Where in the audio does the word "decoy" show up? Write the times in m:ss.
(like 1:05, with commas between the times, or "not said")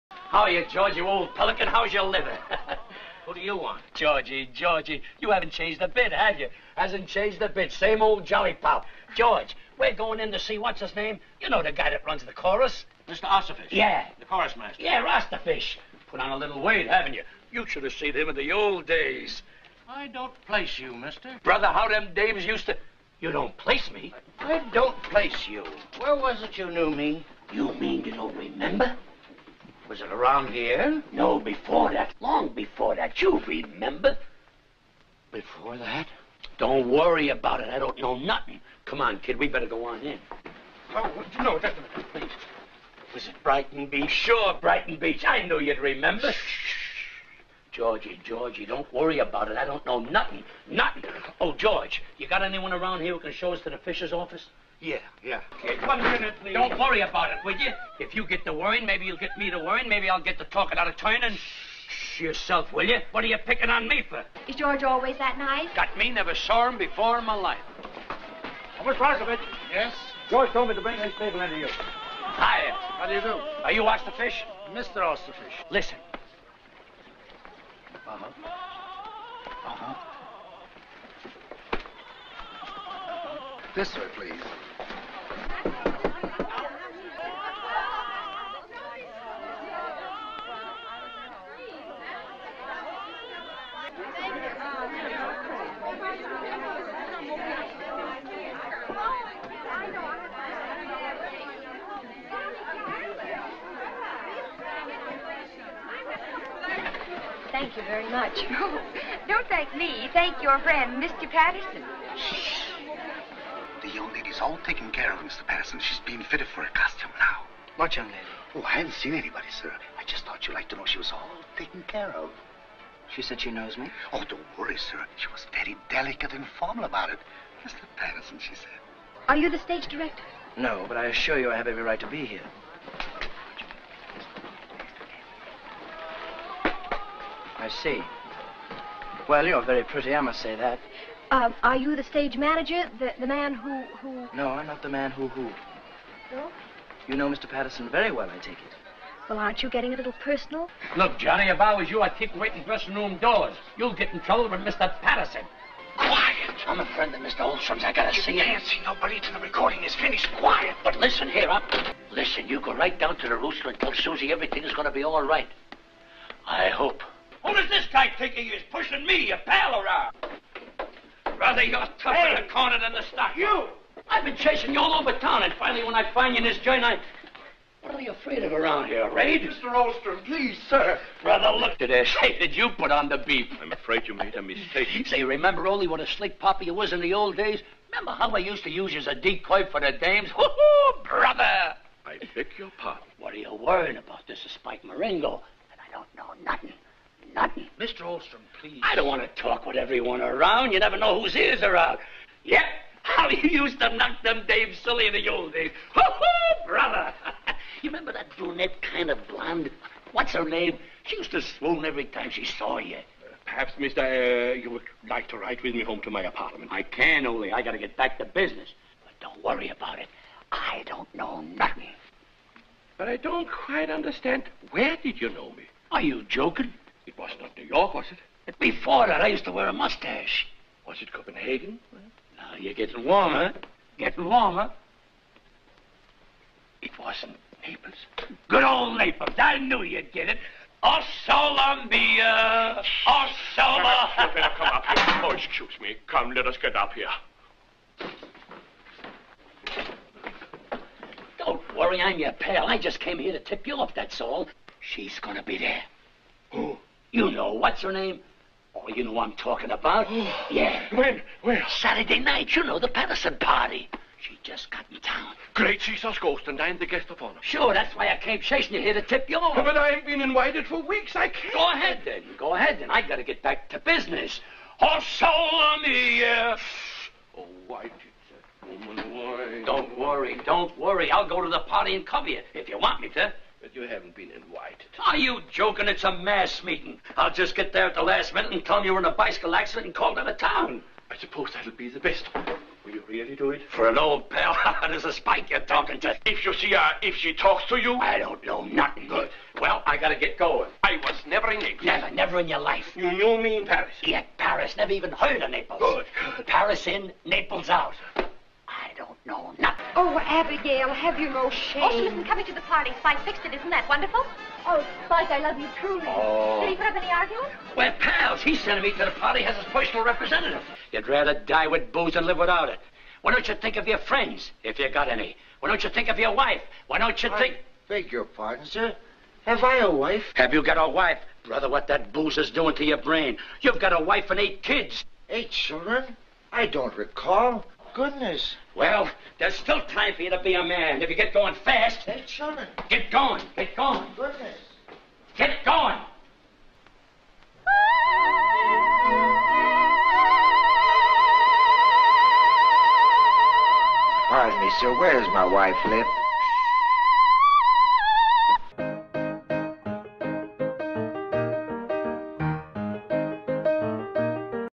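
3:09.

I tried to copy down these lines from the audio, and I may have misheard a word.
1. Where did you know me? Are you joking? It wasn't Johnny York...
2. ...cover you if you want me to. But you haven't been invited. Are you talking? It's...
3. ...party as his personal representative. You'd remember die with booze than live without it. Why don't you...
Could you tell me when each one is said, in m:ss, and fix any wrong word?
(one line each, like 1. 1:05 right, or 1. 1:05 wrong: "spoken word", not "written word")
1. 3:44 wrong: "New", not "Johnny"
2. 4:42 wrong: "joking", not "talking"
3. 5:19 wrong: "rather", not "remember".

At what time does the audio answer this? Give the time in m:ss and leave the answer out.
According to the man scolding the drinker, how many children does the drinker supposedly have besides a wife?
5:34.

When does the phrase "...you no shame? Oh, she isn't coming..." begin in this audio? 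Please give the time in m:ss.
5:11.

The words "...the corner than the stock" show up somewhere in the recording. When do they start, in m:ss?
2:52.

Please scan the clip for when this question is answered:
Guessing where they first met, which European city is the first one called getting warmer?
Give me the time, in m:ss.
3:51.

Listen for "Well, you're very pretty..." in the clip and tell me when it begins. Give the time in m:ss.
2:19.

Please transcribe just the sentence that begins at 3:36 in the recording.
I can, only I gotta get back to business.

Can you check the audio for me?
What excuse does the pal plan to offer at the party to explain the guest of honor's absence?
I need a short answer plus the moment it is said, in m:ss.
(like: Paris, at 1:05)
bicycle accident, at 4:49.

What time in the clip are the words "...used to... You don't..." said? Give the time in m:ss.
0:22.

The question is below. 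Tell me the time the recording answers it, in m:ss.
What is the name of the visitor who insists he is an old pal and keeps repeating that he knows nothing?
3:14.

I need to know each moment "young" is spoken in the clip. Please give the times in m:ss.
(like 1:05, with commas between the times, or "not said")
1:53, 1:57.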